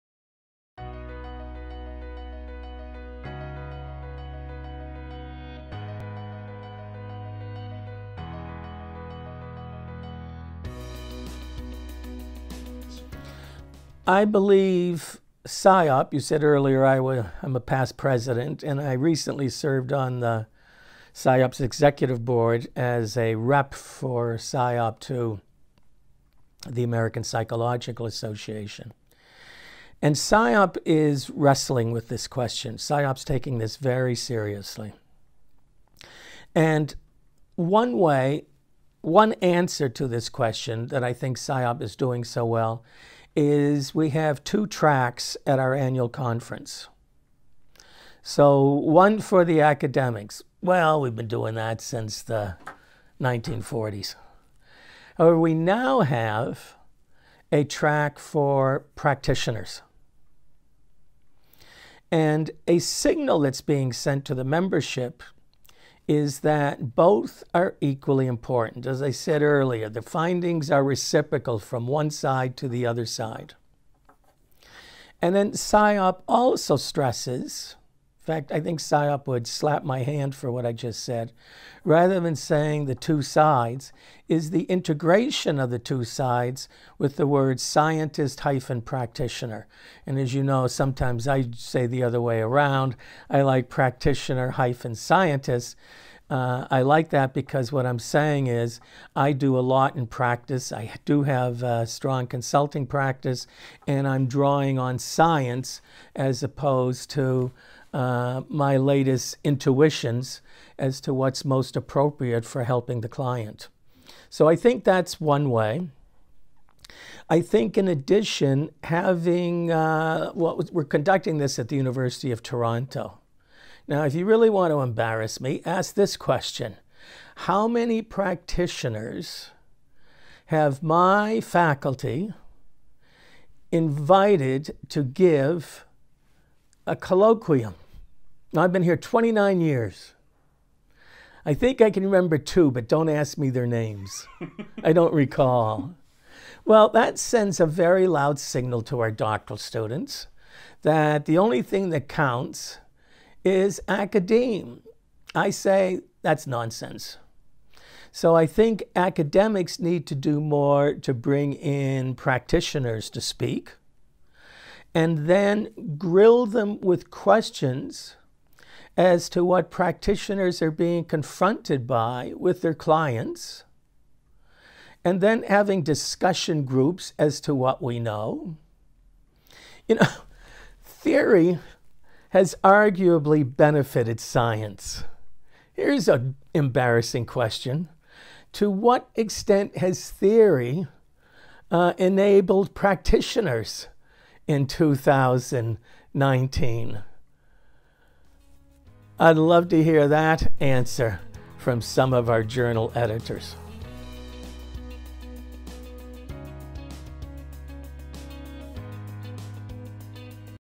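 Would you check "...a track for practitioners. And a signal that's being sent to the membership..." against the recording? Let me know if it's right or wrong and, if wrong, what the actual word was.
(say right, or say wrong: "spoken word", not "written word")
right.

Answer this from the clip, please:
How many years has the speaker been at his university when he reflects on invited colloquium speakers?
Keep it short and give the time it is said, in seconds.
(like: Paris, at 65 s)
29, at 138 s.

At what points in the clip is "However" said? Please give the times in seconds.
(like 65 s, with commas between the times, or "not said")
55 s.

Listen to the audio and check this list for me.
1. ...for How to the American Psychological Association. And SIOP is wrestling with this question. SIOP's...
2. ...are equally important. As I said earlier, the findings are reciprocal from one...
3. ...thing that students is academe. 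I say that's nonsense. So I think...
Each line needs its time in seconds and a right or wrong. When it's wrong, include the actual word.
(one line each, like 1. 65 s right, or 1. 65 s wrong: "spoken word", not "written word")
1. 23 s wrong: "SIOP", not "How"
2. 67 s right
3. 151 s wrong: "counts", not "students".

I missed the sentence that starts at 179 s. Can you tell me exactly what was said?
You know, theory has arguably benefited science.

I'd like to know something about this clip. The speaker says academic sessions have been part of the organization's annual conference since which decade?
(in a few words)
1940s.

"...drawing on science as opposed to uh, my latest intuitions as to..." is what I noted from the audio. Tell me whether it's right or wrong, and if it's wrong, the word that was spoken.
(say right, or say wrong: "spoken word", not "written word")
right.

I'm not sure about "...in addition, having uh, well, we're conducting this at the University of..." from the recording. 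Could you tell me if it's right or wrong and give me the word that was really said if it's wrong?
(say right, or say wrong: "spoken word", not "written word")
right.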